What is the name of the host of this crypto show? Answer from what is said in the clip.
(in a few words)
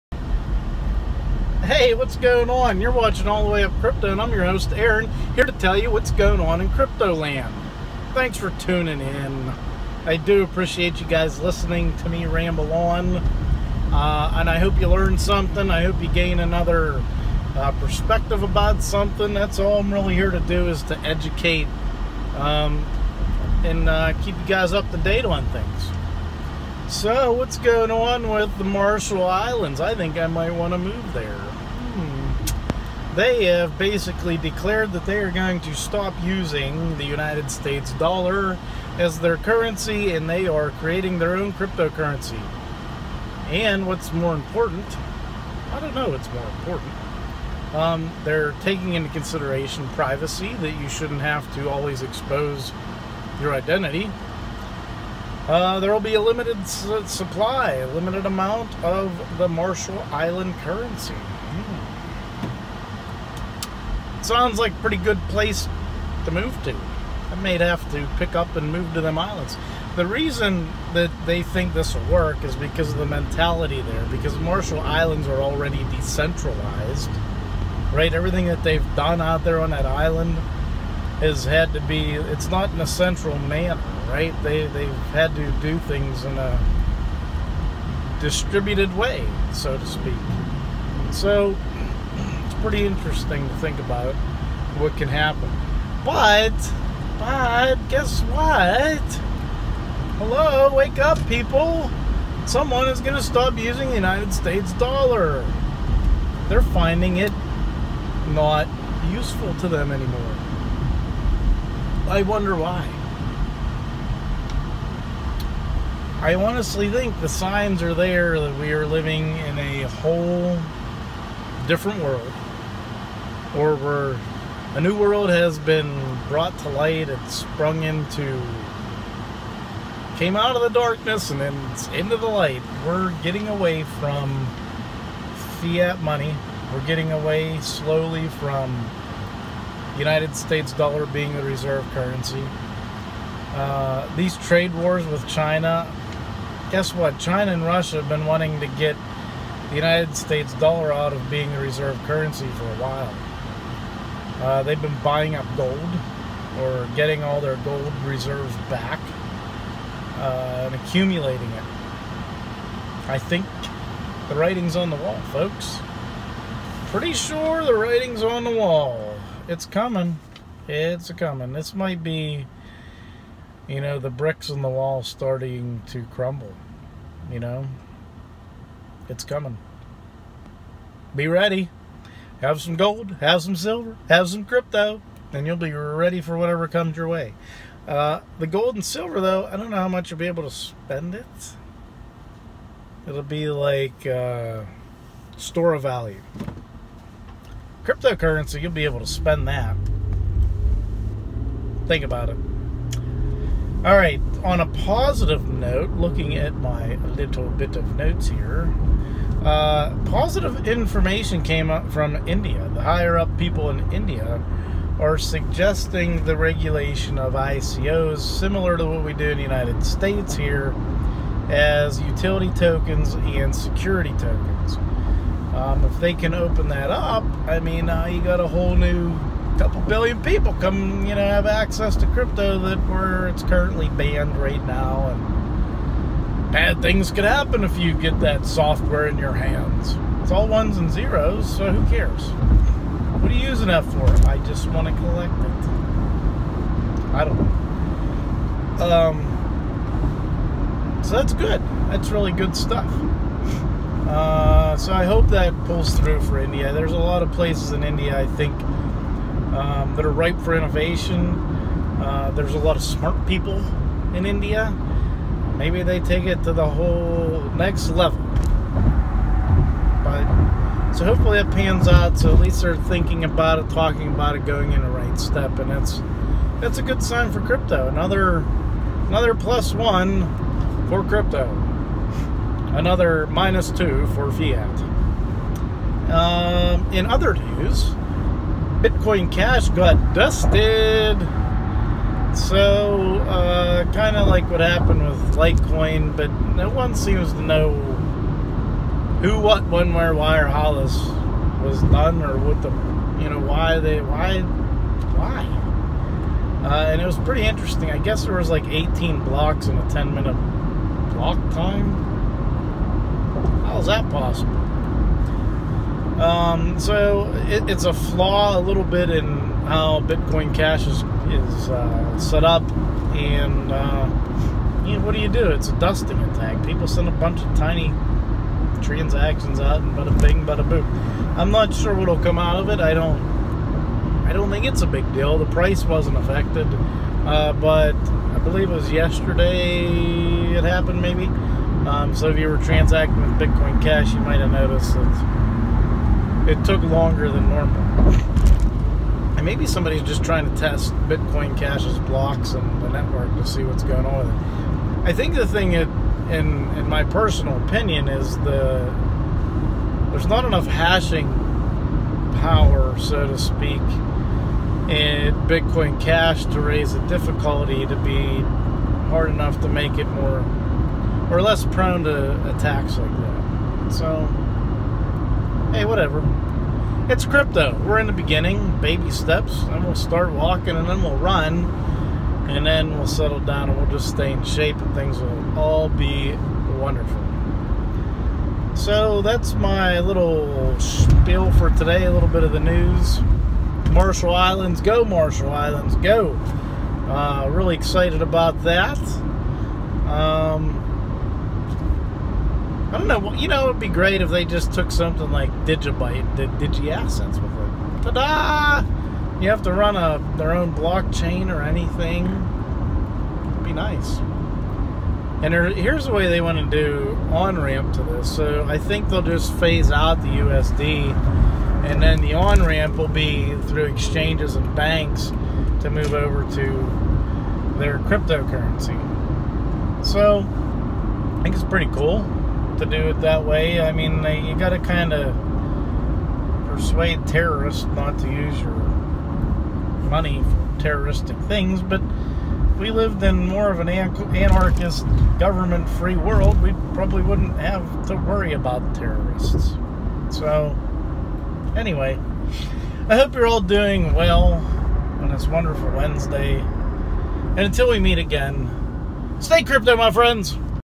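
Aaron.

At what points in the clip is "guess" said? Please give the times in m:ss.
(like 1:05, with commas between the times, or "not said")
1:37, 2:26, 5:07.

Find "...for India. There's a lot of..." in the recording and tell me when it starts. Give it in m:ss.
4:16.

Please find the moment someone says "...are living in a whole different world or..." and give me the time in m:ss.
1:58.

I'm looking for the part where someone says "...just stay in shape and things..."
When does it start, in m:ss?
6:23.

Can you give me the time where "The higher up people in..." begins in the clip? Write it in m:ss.
3:32.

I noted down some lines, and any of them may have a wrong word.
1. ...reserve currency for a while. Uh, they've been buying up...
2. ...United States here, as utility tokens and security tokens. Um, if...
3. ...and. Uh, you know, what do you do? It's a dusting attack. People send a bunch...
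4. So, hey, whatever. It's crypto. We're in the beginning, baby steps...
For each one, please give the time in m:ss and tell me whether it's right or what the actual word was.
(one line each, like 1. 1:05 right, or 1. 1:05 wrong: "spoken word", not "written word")
1. 2:31 right
2. 3:39 right
3. 5:23 right
4. 6:13 right.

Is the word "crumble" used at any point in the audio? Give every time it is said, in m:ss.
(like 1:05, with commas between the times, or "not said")
2:56.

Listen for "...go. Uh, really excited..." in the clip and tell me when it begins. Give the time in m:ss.
6:35.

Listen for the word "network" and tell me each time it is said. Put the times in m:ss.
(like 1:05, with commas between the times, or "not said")
5:52.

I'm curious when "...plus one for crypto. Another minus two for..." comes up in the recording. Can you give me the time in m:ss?
4:39.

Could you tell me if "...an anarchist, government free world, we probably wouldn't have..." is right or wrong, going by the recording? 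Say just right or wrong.
right.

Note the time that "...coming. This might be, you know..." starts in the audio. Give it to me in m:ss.
2:51.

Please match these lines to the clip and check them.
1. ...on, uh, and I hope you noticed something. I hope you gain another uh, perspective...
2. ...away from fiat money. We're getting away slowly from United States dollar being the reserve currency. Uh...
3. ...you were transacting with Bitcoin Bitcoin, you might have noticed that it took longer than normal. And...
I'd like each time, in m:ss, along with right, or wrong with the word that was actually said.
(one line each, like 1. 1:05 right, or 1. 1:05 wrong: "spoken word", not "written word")
1. 0:12 wrong: "learned", not "noticed"
2. 2:13 right
3. 5:42 wrong: "Cash", not "Bitcoin".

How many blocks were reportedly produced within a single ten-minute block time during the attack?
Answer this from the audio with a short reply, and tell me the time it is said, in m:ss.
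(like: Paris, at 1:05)
18, at 5:08.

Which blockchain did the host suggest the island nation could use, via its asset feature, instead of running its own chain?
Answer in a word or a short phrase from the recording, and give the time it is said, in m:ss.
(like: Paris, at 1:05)
DigiByte, at 6:45.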